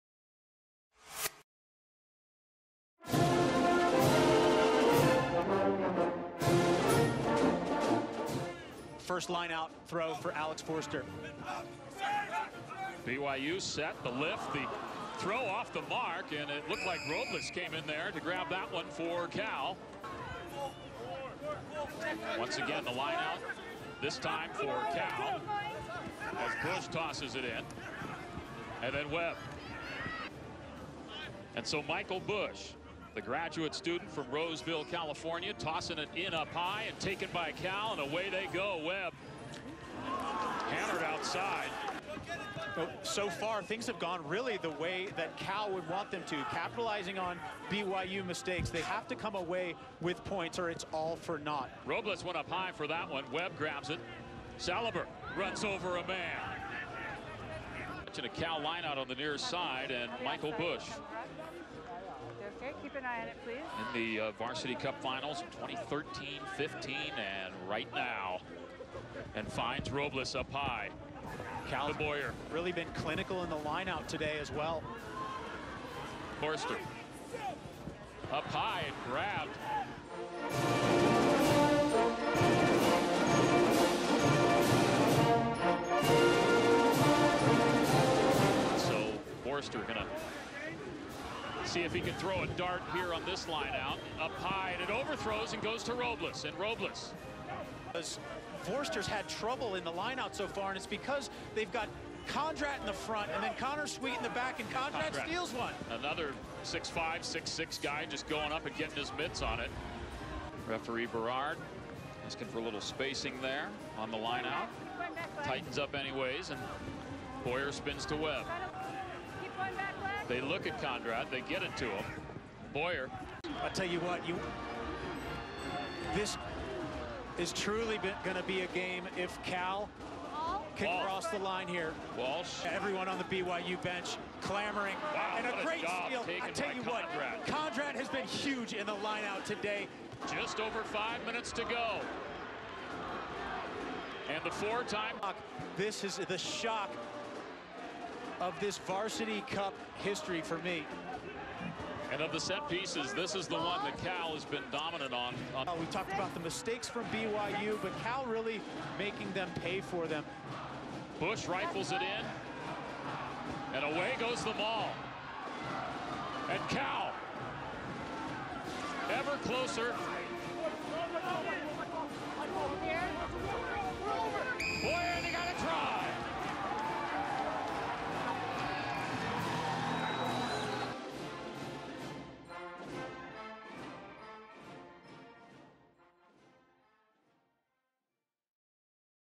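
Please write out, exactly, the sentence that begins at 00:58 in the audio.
Watching a Cal lineout on the near side and Michael Bush Okay, keep an eye on it, please.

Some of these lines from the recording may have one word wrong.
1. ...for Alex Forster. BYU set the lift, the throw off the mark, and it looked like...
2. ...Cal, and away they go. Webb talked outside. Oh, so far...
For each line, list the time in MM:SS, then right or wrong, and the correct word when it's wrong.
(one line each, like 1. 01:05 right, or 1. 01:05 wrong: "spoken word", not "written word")
1. 00:10 right
2. 00:37 wrong: "hammered", not "talked".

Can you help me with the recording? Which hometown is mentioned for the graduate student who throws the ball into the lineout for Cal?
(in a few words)
Roseville, California.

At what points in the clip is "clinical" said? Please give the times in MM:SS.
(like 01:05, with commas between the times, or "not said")
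01:12.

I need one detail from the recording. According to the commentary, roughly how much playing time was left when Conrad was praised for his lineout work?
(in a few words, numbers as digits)
Just over 5 minutes.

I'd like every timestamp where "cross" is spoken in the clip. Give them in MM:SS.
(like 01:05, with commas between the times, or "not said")
02:11.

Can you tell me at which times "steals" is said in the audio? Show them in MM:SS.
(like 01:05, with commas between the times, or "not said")
01:45, 02:15.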